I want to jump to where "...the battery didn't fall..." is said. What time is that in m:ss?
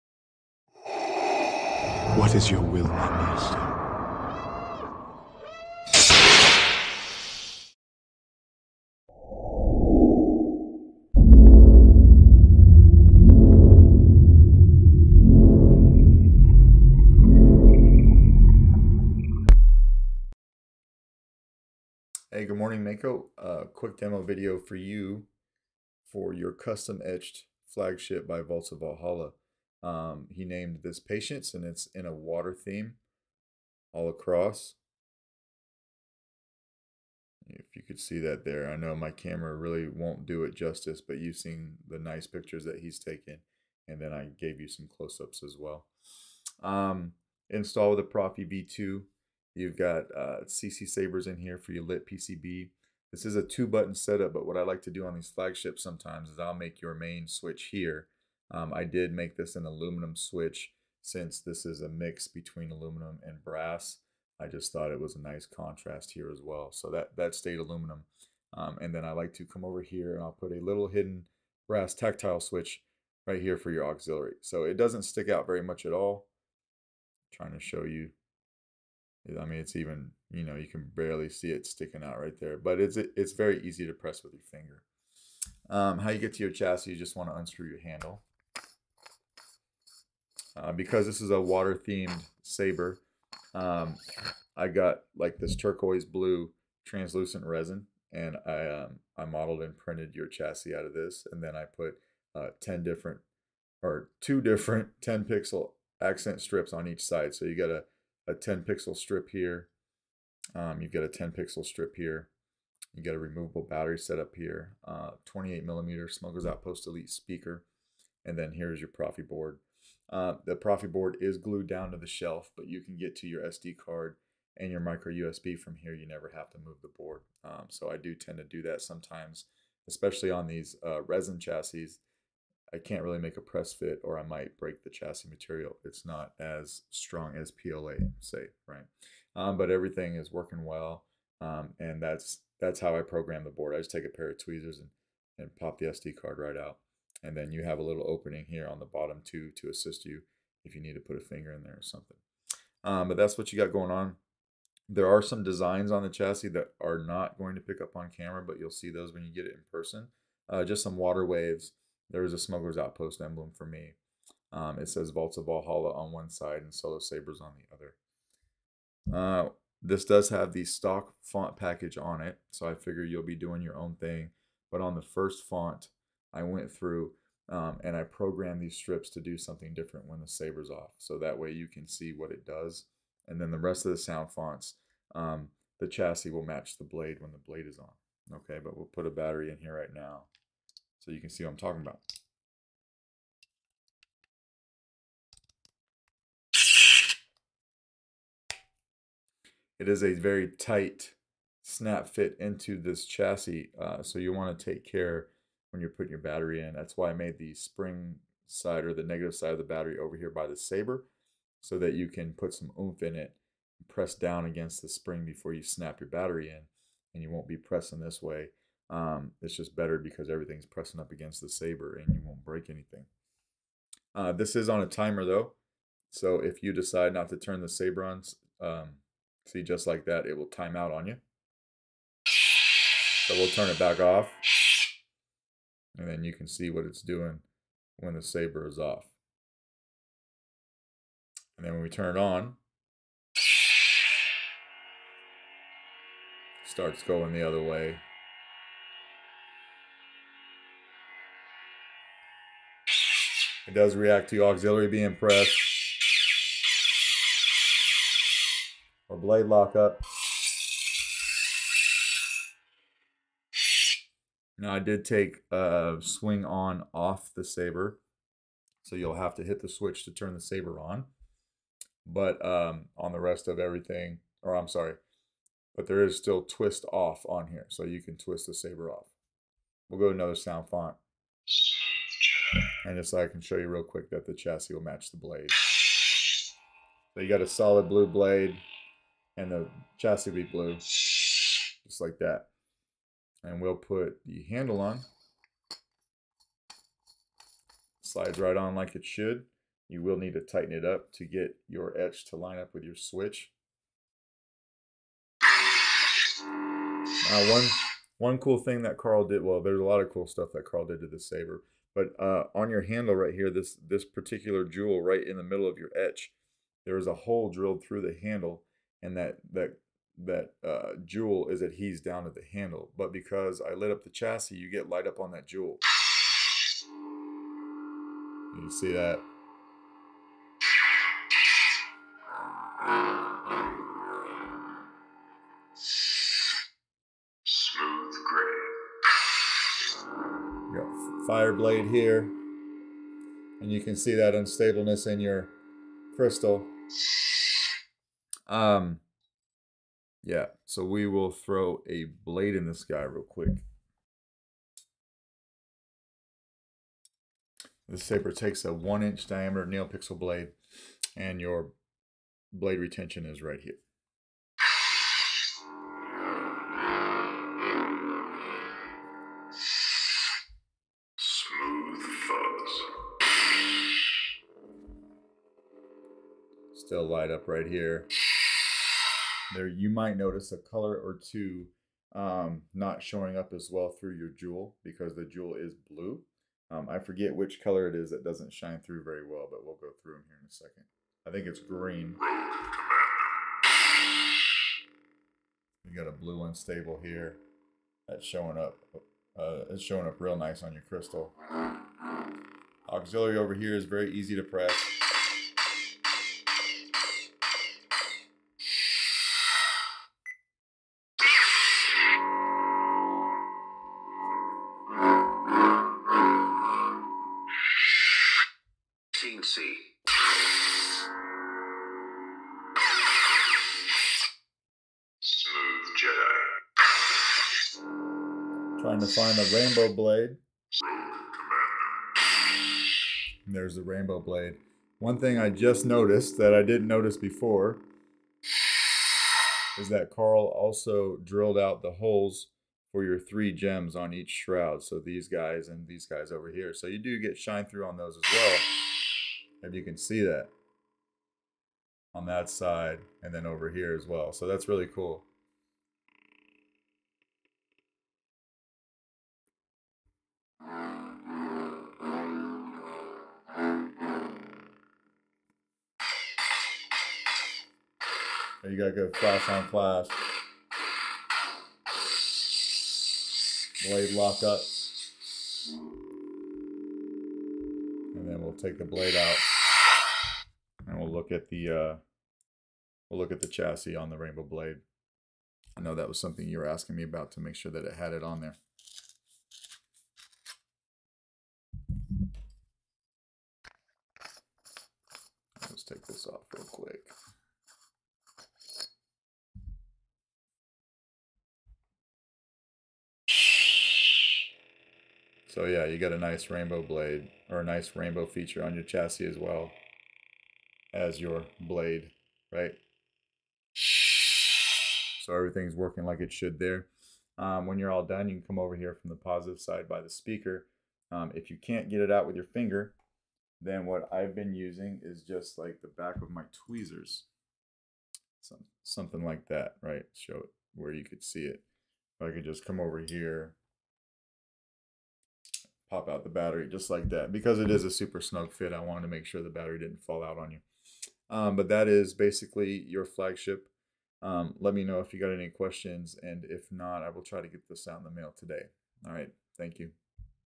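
8:59.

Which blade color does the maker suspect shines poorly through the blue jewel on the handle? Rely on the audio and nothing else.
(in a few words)
green.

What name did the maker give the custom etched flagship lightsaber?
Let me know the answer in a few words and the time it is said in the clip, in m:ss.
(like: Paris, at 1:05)
Patience, at 0:30.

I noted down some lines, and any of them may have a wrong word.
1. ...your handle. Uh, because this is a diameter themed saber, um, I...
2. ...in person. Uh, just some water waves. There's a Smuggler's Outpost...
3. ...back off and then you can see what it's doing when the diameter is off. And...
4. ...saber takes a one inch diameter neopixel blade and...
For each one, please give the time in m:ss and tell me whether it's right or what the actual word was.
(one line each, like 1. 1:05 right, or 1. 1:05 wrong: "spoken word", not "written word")
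1. 1:27 wrong: "water", not "diameter"
2. 2:39 right
3. 3:53 wrong: "saber", not "diameter"
4. 5:58 right.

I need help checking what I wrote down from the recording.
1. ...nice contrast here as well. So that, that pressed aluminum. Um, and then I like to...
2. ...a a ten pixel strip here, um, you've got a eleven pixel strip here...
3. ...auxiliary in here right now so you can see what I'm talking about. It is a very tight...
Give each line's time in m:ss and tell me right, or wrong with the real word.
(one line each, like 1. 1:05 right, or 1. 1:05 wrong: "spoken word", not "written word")
1. 1:05 wrong: "stayed", not "pressed"
2. 1:47 wrong: "ten", not "eleven"
3. 3:09 wrong: "battery", not "auxiliary".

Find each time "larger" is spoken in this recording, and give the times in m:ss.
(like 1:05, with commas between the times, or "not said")
not said.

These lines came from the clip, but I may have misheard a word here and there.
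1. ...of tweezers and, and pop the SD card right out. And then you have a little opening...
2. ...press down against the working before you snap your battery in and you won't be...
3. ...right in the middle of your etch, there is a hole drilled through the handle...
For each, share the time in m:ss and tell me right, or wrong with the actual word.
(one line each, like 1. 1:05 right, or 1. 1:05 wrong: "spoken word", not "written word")
1. 2:24 right
2. 3:33 wrong: "spring", not "working"
3. 5:15 right.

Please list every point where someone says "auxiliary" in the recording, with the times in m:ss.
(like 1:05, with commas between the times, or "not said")
1:13, 4:14, 6:42.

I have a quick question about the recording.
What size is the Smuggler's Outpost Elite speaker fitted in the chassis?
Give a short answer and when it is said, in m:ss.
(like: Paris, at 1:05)
28 millimeter, at 1:55.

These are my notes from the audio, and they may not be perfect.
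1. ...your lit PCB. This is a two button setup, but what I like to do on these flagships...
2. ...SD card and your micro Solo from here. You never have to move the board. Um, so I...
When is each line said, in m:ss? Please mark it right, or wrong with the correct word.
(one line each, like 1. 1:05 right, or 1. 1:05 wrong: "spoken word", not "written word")
1. 0:51 right
2. 2:03 wrong: "USB", not "Solo".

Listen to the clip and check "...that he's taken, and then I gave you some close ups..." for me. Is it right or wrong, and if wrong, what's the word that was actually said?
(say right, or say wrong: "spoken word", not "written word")
right.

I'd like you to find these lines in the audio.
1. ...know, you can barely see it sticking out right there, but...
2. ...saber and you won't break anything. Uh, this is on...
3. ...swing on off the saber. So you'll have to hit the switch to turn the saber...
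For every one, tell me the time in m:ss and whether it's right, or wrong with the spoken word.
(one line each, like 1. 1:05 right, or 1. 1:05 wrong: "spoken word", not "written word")
1. 1:20 right
2. 3:41 right
3. 4:26 right.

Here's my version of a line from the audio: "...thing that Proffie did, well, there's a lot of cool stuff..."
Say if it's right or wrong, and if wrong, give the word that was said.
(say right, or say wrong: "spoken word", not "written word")
wrong: "Carl", not "Proffie".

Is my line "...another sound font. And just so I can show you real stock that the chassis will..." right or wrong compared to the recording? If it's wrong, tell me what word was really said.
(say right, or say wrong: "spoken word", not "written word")
wrong: "quick", not "stock".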